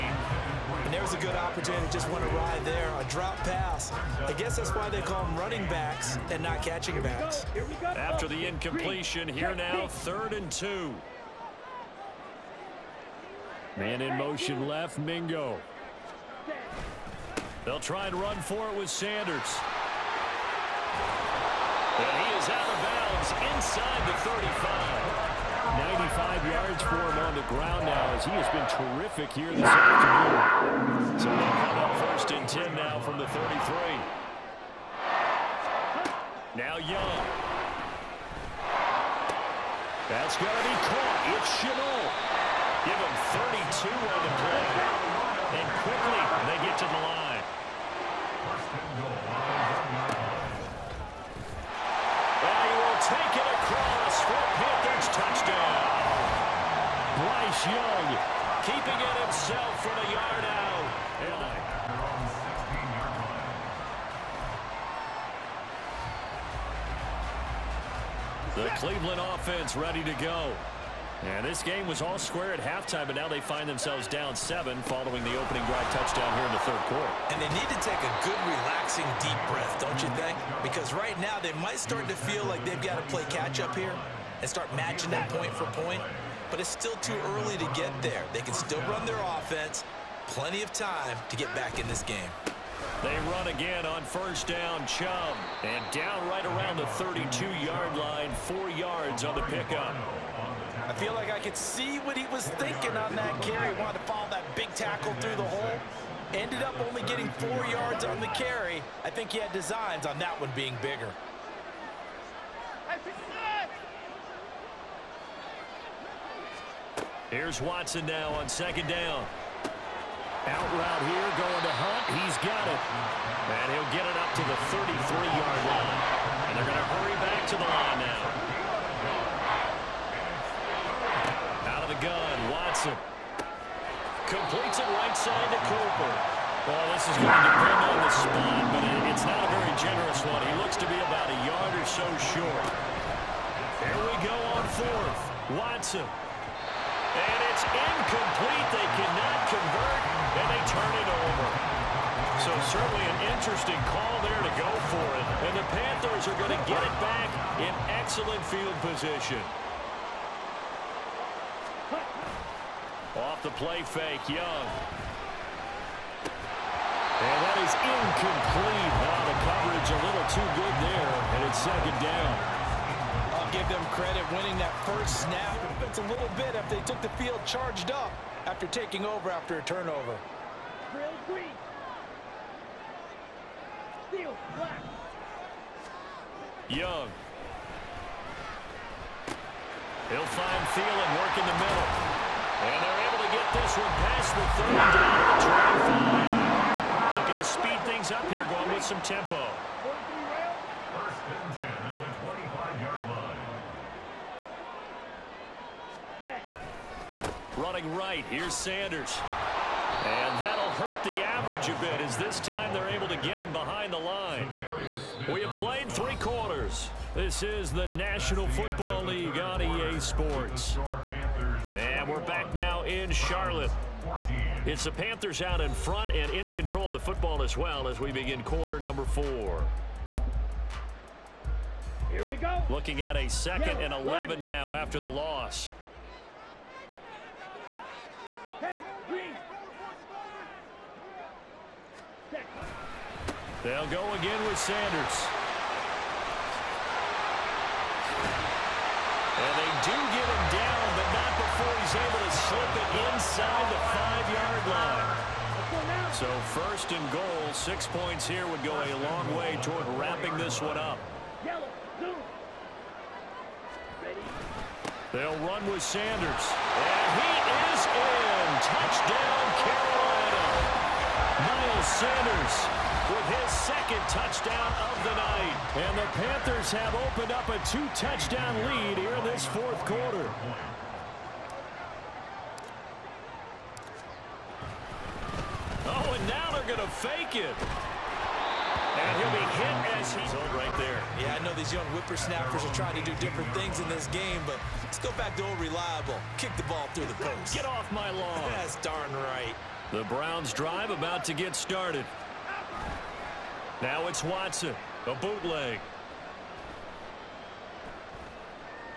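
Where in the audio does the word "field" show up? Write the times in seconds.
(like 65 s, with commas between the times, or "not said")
158 s, 177 s.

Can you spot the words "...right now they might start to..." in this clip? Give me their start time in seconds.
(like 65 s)
80 s.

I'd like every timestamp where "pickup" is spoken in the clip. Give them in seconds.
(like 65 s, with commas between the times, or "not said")
99 s.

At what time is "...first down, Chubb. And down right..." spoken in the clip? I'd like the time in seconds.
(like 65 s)
94 s.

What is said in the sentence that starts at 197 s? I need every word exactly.
Looking to speed things up here, going with some tempo.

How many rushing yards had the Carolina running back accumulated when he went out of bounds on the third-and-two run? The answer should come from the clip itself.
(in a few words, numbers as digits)
95.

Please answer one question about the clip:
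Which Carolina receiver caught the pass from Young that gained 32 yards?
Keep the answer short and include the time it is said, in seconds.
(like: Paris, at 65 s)
Chenault, at 41 s.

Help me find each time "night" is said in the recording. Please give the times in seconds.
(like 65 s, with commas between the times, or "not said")
275 s.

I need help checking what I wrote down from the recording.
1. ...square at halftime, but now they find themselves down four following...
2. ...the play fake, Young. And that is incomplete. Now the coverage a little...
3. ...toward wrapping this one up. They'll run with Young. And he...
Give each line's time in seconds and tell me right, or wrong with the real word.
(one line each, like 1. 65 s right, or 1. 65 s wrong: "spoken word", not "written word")
1. 72 s wrong: "seven", not "four"
2. 163 s right
3. 259 s wrong: "Sanders", not "Young".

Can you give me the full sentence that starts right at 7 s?
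After the incompletion, here now, third and two.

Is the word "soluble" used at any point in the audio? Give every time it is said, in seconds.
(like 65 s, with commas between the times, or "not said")
not said.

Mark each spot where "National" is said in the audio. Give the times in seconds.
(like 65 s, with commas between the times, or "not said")
217 s.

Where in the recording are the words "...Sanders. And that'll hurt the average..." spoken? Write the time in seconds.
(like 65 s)
208 s.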